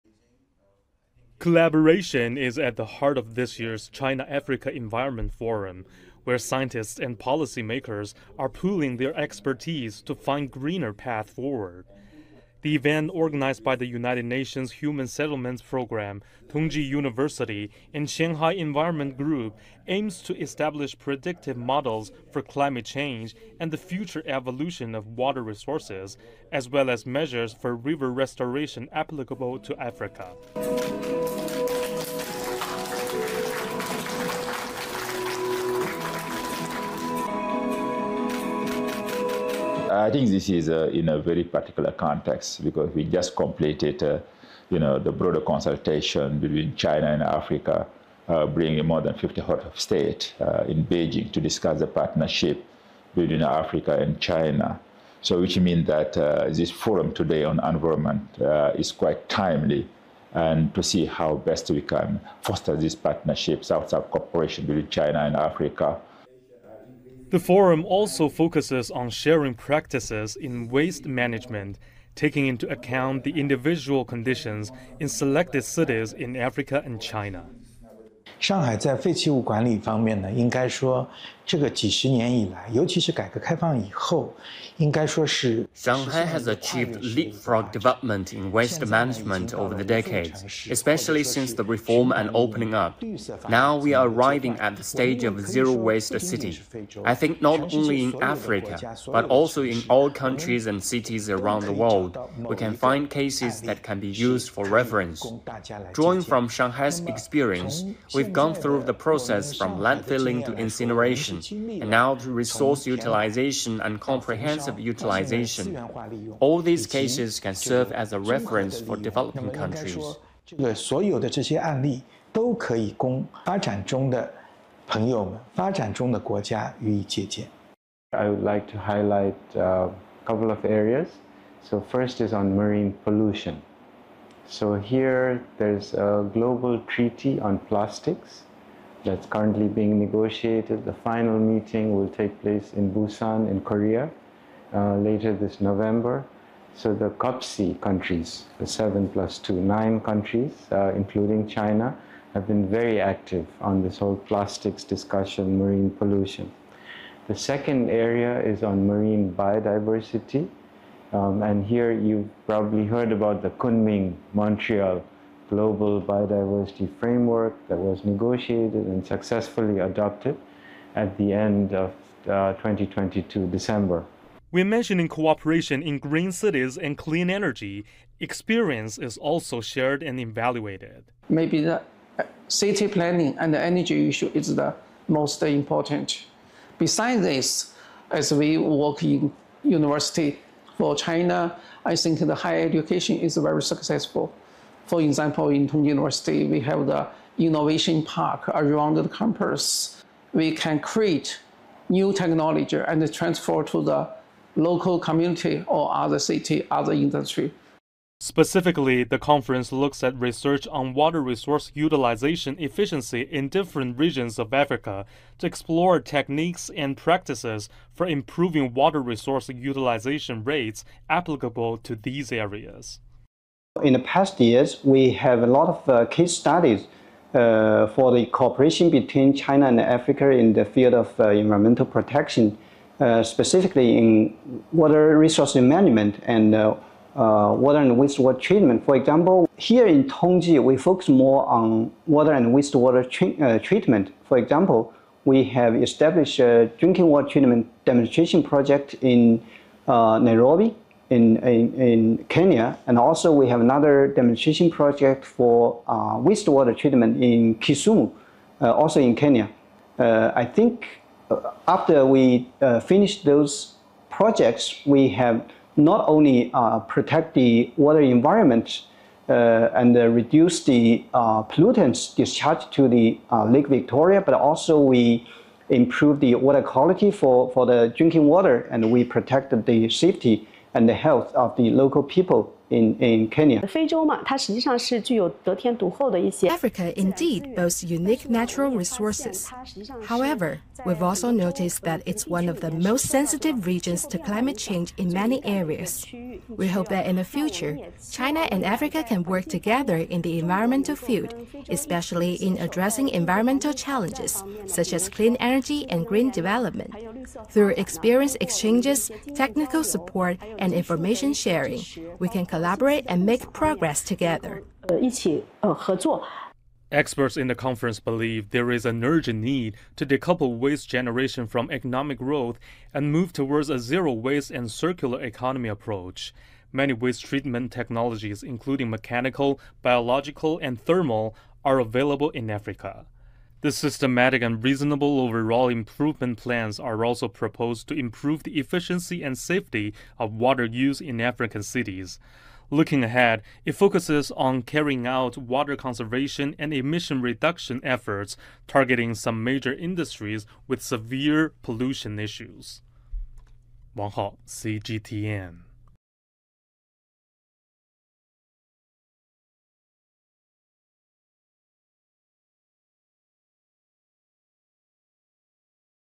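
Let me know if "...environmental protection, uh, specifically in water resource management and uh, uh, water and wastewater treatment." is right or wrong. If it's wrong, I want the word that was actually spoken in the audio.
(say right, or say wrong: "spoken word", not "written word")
right.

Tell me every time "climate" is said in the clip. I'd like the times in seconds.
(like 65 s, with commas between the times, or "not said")
22 s, 294 s.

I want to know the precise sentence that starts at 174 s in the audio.
We're mentioning cooperation in green cities and clean energy, experience is also shared and evaluated.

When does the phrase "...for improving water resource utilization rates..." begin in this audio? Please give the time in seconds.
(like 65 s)
217 s.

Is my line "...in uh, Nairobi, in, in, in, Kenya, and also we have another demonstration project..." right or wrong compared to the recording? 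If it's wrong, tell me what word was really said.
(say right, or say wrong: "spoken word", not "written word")
right.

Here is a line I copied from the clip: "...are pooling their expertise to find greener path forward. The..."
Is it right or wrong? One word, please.
right.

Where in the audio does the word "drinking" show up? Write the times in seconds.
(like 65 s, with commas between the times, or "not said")
246 s, 277 s.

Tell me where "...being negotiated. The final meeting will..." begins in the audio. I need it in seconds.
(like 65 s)
139 s.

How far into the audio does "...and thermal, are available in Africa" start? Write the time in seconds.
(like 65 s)
330 s.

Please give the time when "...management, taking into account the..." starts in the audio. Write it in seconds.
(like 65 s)
71 s.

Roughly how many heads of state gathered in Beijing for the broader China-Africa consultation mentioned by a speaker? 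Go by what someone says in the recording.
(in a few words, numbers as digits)
more than 50.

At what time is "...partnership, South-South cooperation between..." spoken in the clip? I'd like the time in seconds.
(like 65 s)
62 s.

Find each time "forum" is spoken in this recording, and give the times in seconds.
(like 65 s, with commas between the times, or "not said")
5 s, 56 s, 67 s.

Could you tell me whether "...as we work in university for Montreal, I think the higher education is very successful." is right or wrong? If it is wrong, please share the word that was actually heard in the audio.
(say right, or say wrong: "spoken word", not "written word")
wrong: "China", not "Montreal".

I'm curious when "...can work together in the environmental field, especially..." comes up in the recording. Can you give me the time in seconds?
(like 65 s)
299 s.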